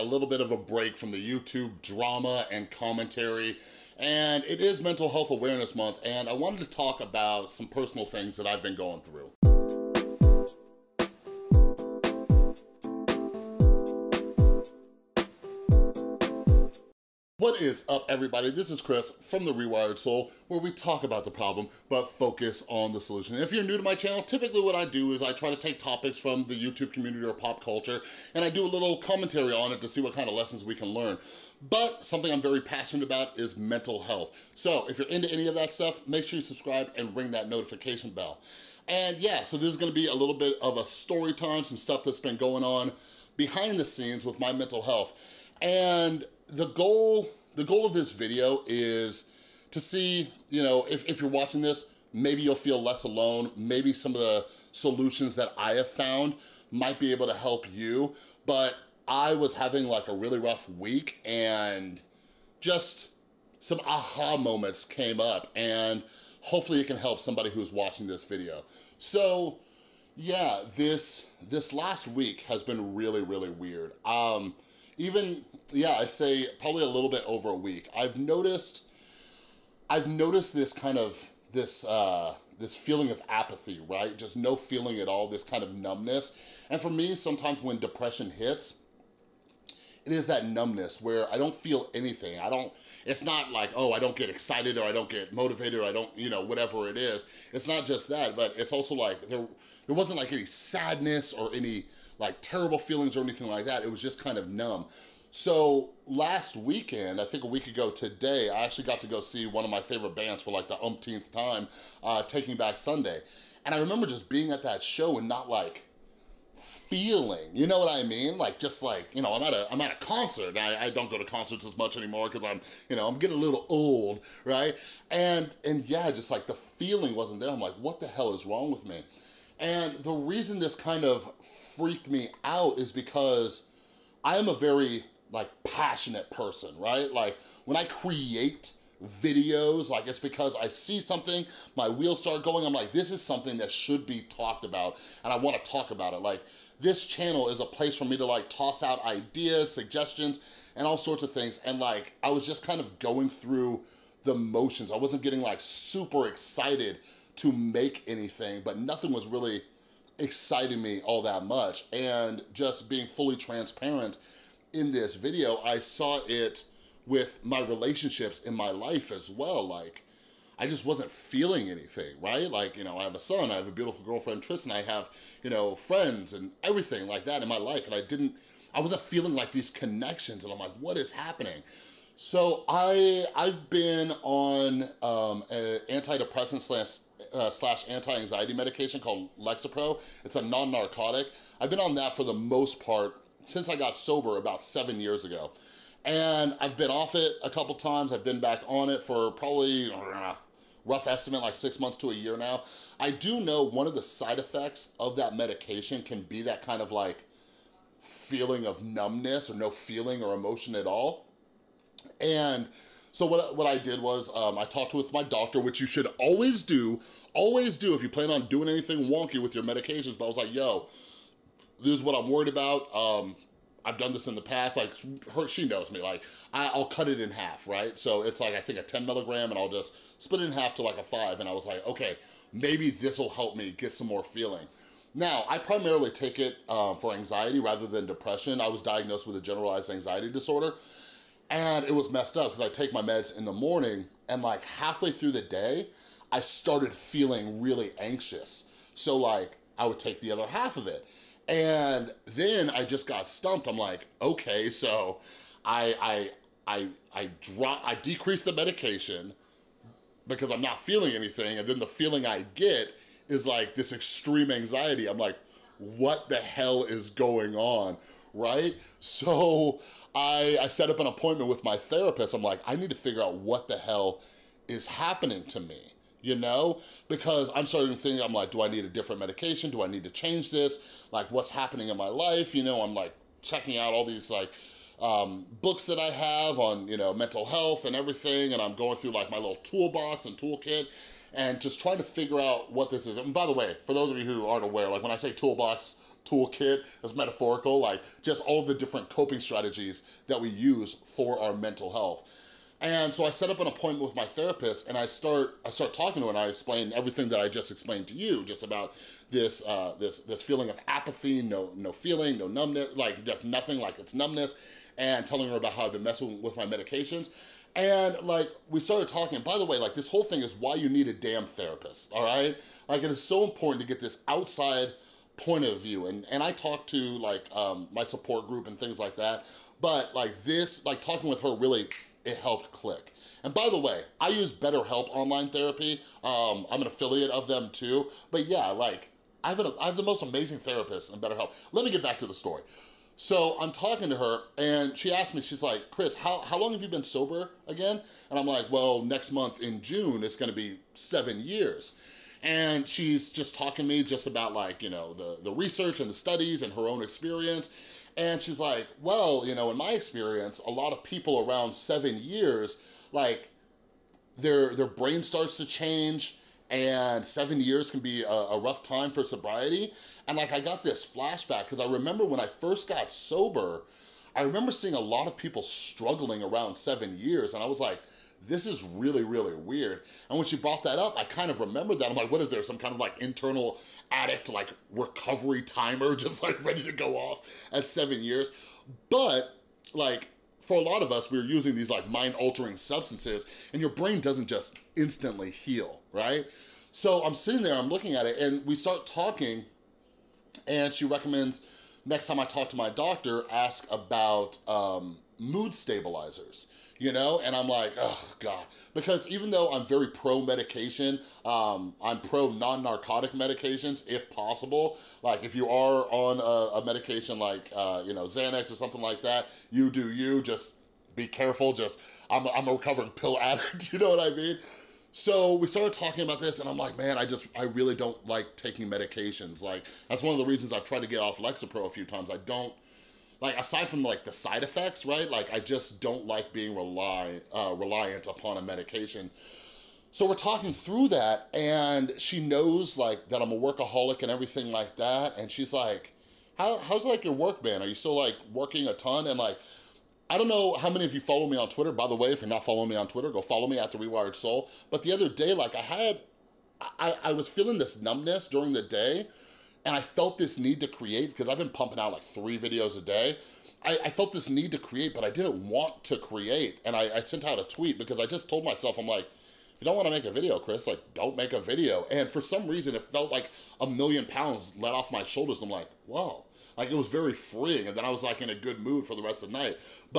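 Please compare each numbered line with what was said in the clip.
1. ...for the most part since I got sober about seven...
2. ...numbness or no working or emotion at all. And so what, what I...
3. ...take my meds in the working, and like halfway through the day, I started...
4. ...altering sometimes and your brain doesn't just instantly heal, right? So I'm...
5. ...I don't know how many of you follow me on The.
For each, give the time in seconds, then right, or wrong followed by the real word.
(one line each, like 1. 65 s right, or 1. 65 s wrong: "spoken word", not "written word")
1. 192 s right
2. 208 s wrong: "feeling", not "working"
3. 242 s wrong: "morning", not "working"
4. 392 s wrong: "substances", not "sometimes"
5. 450 s wrong: "Twitter", not "The".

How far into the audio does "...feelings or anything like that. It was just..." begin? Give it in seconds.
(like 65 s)
102 s.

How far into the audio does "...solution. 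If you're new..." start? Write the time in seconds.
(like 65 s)
23 s.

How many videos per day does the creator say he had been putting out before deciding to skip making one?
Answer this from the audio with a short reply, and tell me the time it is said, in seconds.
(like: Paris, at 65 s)
3, at 462 s.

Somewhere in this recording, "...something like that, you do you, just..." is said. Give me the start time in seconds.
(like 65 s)
418 s.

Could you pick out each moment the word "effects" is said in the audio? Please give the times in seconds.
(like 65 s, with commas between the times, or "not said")
204 s, 434 s.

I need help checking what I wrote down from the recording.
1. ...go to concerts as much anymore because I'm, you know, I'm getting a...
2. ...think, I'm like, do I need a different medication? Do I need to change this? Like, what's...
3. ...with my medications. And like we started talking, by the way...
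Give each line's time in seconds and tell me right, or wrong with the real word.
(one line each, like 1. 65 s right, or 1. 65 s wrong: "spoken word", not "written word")
1. 121 s right
2. 277 s right
3. 316 s right.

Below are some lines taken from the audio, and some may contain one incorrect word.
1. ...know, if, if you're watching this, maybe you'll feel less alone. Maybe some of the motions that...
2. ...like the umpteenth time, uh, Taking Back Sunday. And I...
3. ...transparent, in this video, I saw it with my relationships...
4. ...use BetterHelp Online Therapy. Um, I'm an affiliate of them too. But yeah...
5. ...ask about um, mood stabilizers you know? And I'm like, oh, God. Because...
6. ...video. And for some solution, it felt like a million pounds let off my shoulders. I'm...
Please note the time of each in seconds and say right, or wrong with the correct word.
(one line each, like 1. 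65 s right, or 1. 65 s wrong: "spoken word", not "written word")
1. 50 s wrong: "solutions", not "motions"
2. 110 s right
3. 163 s right
4. 334 s right
5. 403 s right
6. 471 s wrong: "reason", not "solution".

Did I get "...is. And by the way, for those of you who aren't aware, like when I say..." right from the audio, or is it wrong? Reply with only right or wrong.
right.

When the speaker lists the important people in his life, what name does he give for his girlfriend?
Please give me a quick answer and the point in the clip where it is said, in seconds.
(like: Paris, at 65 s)
Tristan, at 174 s.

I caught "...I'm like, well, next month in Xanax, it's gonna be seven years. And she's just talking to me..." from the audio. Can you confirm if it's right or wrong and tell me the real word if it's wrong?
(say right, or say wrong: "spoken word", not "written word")
wrong: "June", not "Xanax".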